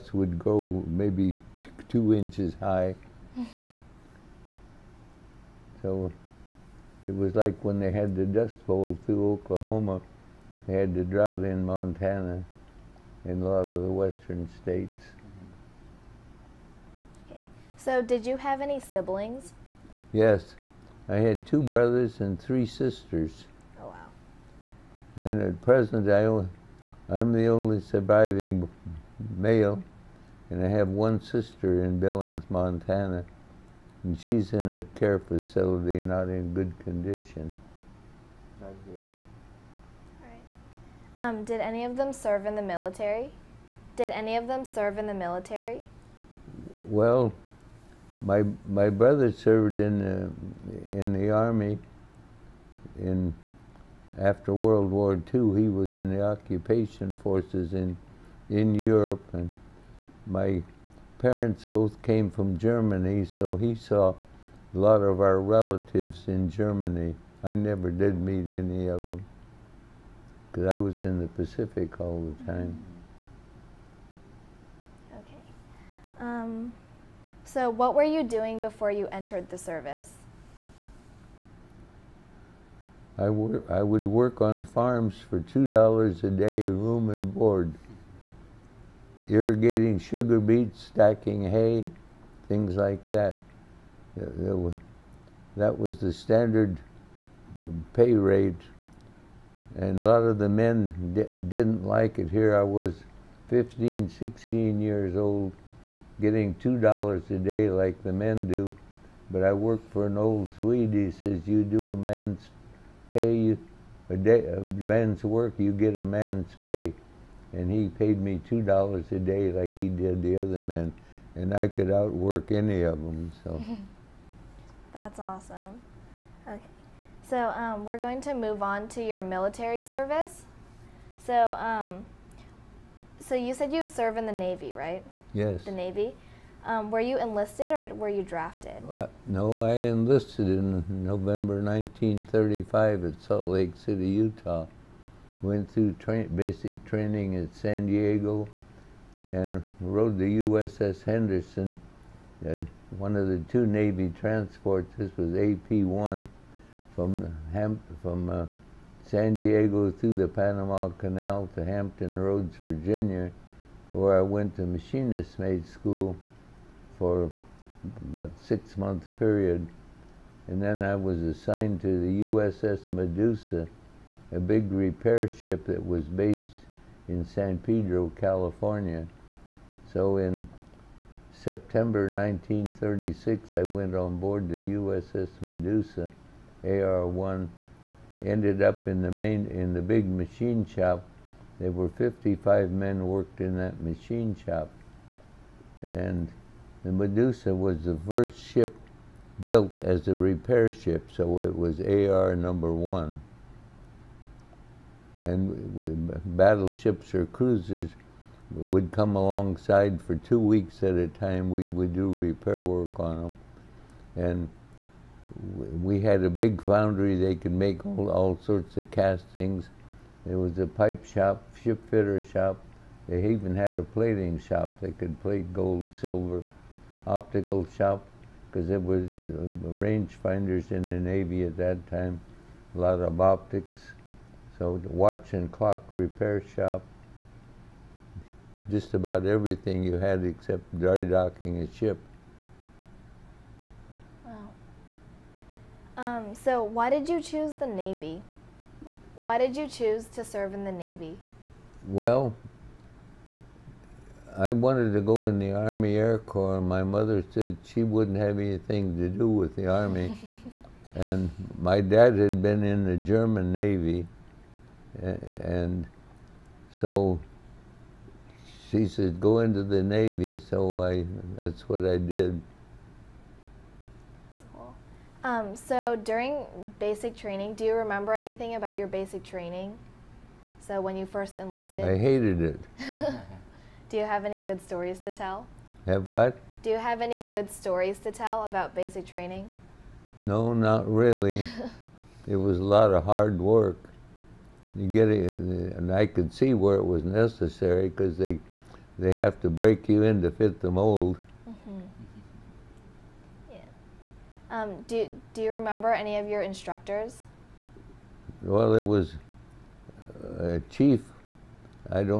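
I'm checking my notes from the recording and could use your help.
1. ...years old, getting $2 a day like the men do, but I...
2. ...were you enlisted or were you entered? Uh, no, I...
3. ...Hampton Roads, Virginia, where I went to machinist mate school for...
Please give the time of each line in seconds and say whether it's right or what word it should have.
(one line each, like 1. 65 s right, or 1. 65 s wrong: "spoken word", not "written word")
1. 104 s right
2. 136 s wrong: "drafted", not "entered"
3. 161 s right.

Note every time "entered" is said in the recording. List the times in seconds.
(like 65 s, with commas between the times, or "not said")
79 s.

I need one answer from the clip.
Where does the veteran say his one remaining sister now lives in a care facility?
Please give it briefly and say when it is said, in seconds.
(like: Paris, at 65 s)
Billings, Montana, at 31 s.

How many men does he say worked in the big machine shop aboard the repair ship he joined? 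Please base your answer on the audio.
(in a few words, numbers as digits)
55.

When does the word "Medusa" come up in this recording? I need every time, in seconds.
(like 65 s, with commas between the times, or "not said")
172 s, 185 s, 196 s.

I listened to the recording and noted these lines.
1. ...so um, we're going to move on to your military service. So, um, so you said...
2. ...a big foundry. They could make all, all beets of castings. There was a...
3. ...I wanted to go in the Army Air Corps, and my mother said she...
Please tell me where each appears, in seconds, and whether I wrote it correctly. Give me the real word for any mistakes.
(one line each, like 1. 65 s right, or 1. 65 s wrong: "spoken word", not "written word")
1. 127 s right
2. 216 s wrong: "sorts", not "beets"
3. 254 s right.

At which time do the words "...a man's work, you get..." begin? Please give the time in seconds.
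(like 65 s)
114 s.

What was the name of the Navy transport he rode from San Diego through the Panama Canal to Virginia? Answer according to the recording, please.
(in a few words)
USS Henderson.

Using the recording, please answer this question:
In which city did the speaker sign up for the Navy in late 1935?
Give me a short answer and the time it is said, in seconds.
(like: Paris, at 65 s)
Salt Lake City, at 143 s.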